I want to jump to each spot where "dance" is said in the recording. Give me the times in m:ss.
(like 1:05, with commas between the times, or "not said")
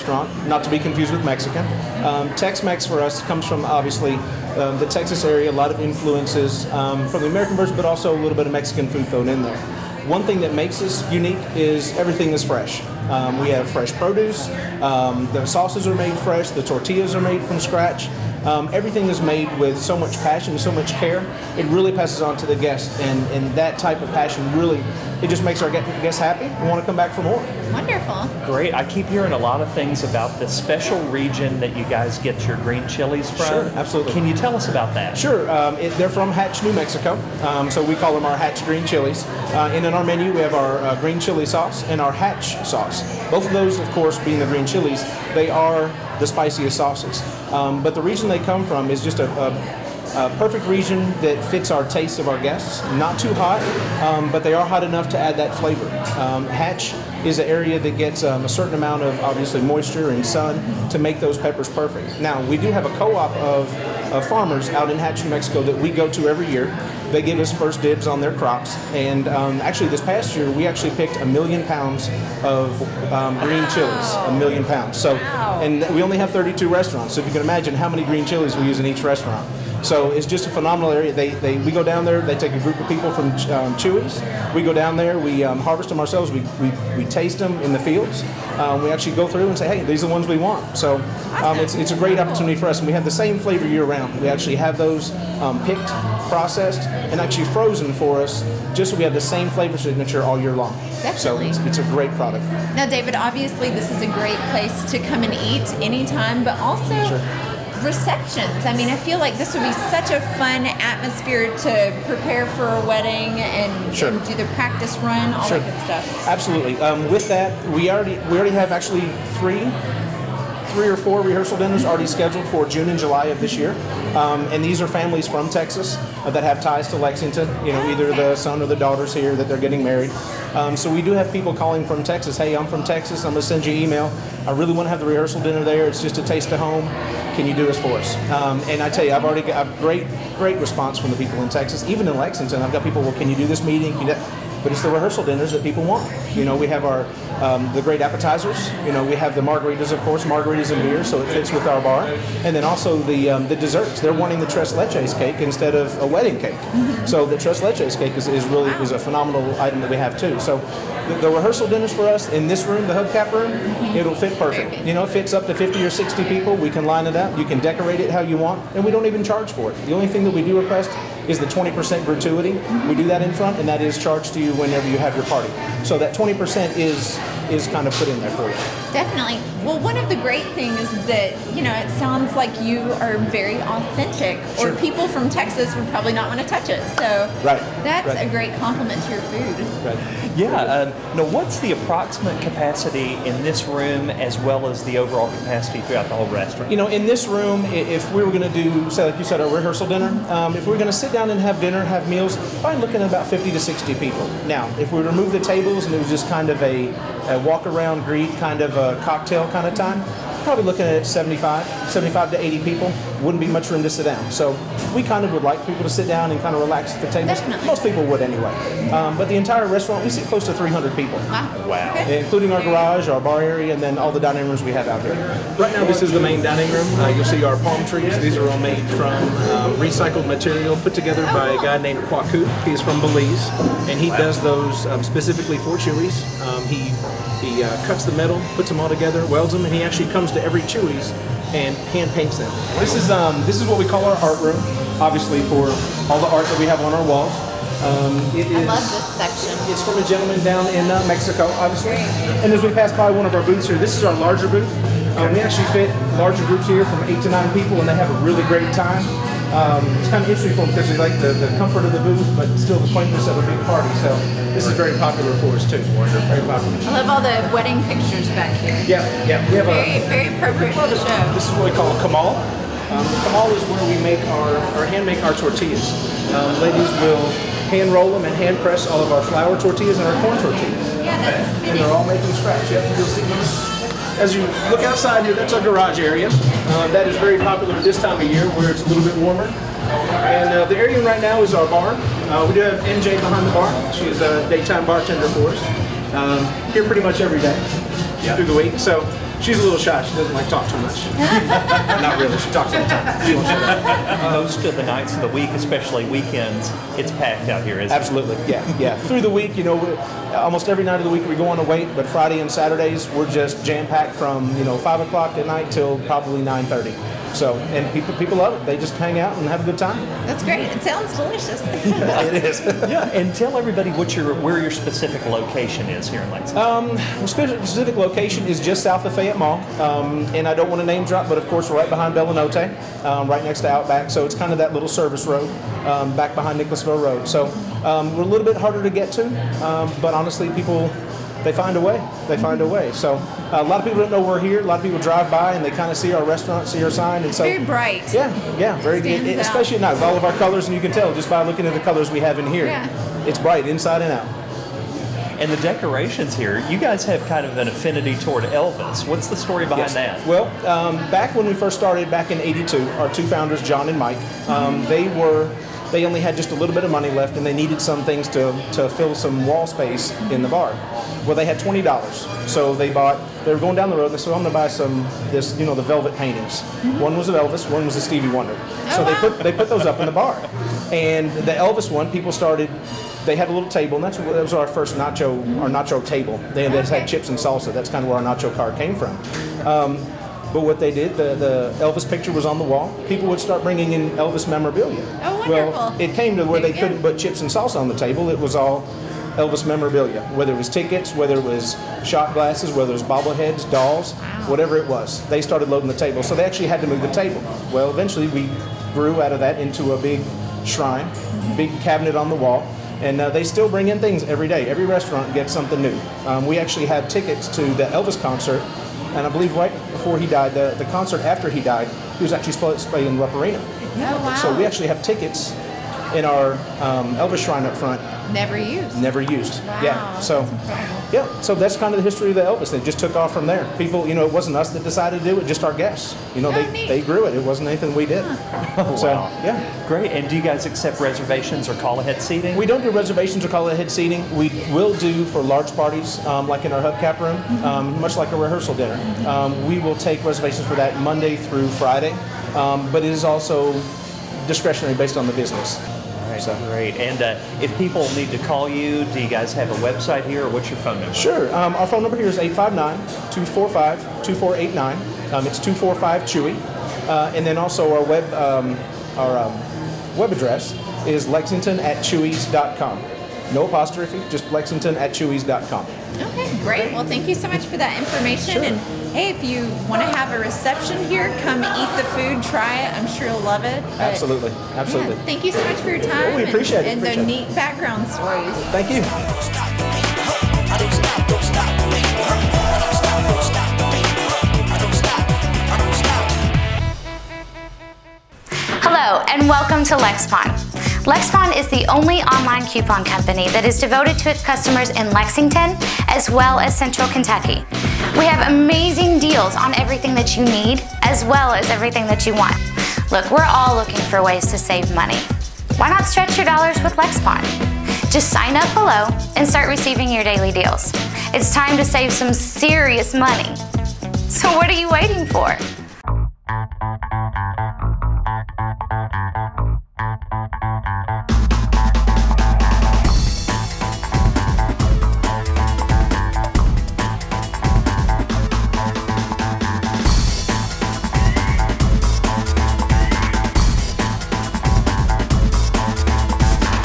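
not said.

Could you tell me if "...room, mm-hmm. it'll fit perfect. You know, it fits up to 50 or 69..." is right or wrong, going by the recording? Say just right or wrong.
wrong.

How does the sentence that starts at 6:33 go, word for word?
People would start bringing in Elvis memorabilia.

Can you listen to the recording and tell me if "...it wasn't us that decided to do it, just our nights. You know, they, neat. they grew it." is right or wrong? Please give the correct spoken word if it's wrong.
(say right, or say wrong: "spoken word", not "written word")
wrong: "guests", not "nights".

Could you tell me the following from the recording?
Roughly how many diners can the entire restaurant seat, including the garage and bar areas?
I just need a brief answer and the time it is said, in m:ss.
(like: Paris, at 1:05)
300, at 3:40.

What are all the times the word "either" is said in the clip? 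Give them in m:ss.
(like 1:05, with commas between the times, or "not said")
2:07.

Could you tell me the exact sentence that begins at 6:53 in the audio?
And uh, they still bring in things every day.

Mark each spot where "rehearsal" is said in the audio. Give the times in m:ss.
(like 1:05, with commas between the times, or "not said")
2:01, 2:15, 2:24, 2:41, 3:19, 7:28.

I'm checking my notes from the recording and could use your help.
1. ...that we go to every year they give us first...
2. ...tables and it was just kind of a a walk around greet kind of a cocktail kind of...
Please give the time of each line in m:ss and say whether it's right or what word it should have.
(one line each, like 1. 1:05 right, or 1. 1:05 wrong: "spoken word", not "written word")
1. 1:05 right
2. 3:25 right.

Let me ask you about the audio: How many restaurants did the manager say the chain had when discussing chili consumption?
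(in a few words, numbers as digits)
32.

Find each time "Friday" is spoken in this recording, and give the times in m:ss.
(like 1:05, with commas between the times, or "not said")
5:12, 7:31.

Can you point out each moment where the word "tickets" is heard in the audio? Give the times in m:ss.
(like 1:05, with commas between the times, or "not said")
6:40, 6:57, 7:05.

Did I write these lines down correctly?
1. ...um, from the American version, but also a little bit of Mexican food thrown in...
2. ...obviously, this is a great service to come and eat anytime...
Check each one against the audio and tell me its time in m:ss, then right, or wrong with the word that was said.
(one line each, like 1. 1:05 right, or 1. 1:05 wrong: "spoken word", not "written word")
1. 0:06 right
2. 1:43 wrong: "place", not "service".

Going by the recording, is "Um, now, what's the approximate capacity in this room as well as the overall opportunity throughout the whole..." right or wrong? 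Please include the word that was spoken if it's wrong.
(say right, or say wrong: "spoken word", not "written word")
wrong: "capacity", not "opportunity".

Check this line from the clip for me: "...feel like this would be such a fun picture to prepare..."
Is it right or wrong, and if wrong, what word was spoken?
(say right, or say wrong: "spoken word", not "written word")
wrong: "atmosphere", not "picture".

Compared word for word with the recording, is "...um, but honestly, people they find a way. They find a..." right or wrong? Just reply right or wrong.
right.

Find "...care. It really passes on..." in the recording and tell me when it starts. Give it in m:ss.
0:20.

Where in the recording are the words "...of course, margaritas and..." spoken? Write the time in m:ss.
2:29.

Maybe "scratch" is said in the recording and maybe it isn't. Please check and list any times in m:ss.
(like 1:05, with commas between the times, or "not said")
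0:17, 4:42.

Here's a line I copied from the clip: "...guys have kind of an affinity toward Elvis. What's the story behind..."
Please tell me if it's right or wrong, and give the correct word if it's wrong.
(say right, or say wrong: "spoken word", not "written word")
right.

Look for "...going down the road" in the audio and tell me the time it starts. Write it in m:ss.
6:13.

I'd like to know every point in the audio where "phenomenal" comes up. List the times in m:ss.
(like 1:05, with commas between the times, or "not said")
1:20, 2:38.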